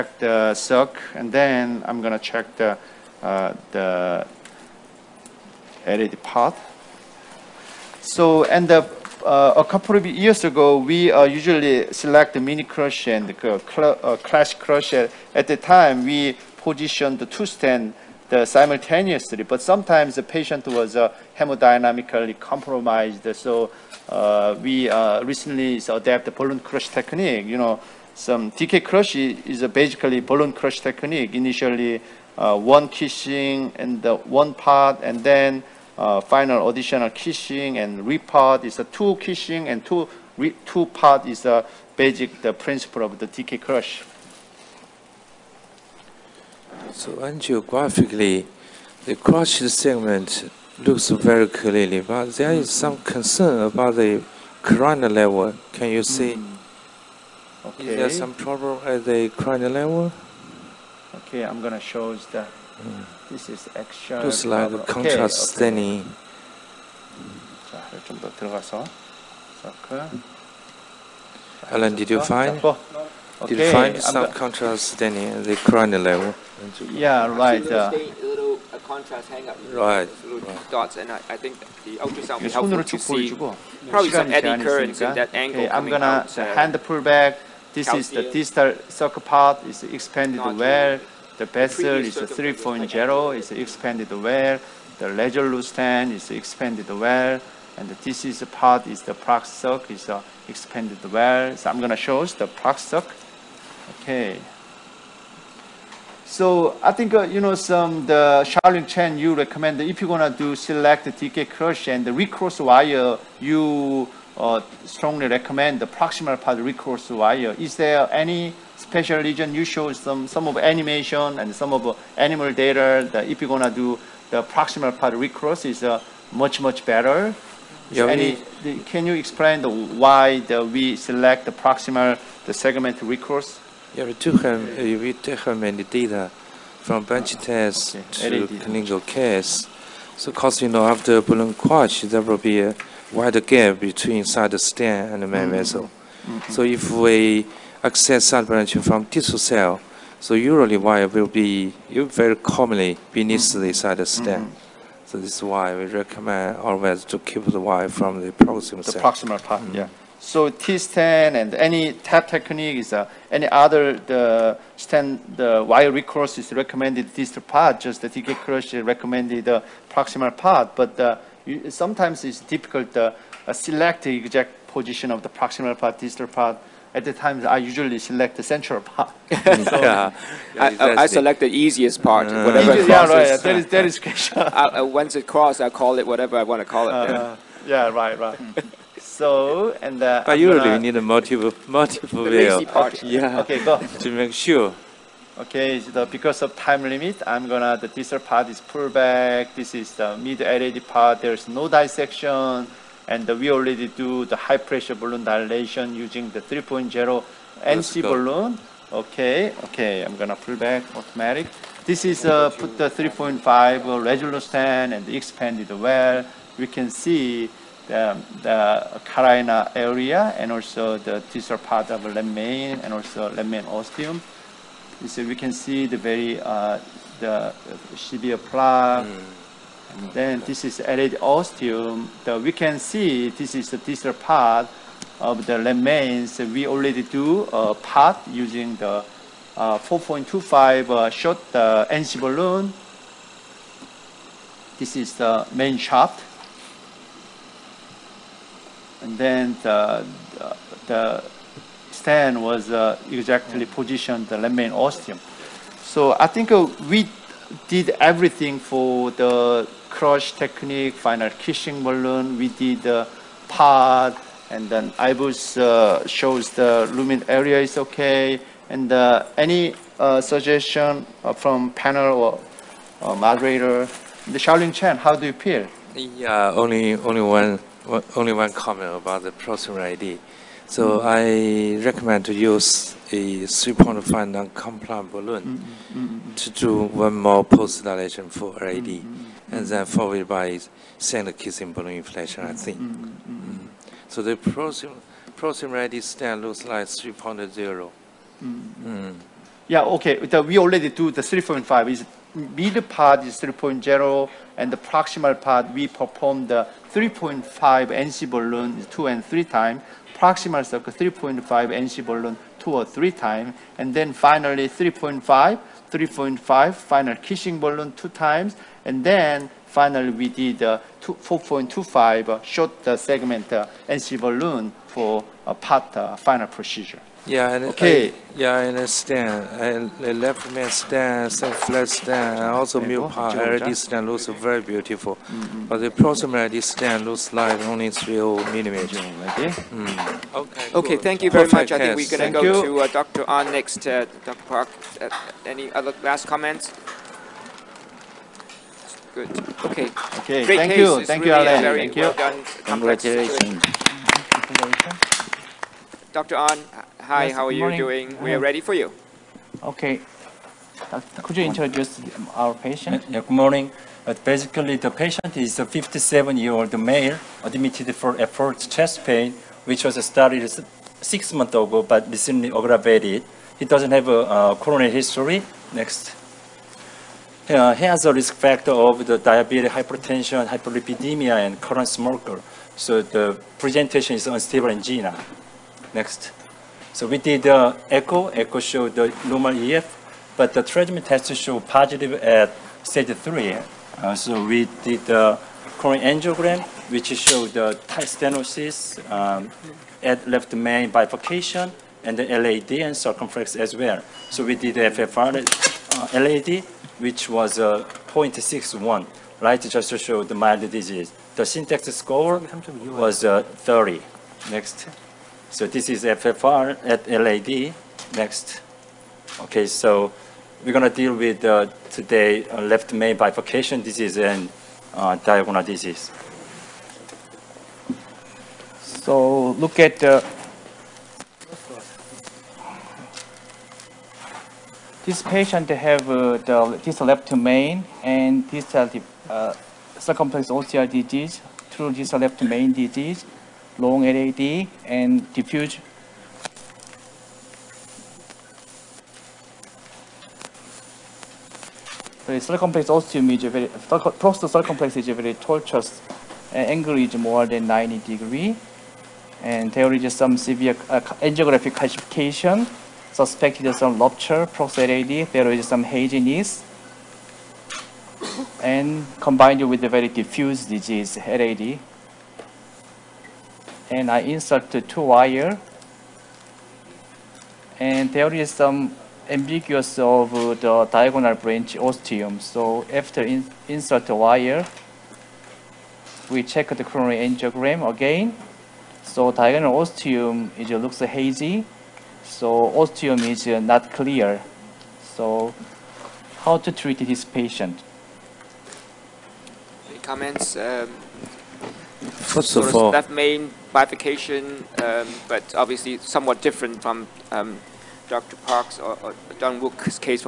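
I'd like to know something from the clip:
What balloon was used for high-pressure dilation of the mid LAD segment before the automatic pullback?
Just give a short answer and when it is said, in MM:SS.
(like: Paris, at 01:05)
3.0 NC balloon, at 03:26.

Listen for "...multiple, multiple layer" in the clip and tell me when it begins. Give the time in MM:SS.
03:10.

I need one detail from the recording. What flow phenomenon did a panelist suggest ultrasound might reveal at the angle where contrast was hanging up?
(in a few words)
eddy currents.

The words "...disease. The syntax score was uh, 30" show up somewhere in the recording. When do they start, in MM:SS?
06:50.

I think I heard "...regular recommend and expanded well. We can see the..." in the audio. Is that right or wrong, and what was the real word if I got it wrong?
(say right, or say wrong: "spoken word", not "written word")
wrong: "stand", not "recommend".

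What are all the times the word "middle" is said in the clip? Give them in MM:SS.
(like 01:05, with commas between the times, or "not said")
05:02.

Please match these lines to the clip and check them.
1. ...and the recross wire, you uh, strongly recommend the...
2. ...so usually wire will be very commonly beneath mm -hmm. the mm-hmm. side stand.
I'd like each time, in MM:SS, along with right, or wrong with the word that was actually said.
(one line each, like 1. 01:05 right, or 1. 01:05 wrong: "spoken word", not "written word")
1. 01:51 right
2. 02:30 right.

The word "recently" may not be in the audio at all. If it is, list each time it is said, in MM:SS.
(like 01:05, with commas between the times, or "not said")
00:25, 06:12.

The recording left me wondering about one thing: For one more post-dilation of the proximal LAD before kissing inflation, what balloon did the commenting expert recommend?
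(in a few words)
3.5 non-compliant balloon.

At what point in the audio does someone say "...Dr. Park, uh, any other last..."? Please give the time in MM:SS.
05:44.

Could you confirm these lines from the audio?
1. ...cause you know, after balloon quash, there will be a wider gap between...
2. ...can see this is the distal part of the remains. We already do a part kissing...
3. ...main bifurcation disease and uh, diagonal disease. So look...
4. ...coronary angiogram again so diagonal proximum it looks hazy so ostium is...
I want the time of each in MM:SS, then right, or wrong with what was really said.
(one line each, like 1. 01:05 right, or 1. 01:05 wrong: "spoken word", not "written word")
1. 02:20 right
2. 03:52 wrong: "using", not "kissing"
3. 07:02 right
4. 08:06 wrong: "ostium", not "proximum".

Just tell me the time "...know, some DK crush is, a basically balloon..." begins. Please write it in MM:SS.
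00:27.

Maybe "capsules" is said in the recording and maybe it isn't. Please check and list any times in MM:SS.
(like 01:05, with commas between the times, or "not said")
not said.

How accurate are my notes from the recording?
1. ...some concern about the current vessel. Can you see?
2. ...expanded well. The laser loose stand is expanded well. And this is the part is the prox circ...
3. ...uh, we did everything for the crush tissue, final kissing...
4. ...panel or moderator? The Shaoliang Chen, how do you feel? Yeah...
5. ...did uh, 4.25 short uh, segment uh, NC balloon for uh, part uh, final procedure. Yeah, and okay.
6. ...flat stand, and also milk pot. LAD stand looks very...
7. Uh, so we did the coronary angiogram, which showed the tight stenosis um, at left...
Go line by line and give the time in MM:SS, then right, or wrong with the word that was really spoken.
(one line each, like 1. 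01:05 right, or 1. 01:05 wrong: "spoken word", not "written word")
1. 00:52 wrong: "level", not "vessel"
2. 01:33 right
3. 04:16 wrong: "technique", not "tissue"
4. 04:31 right
5. 05:20 right
6. 05:31 right
7. 06:33 right.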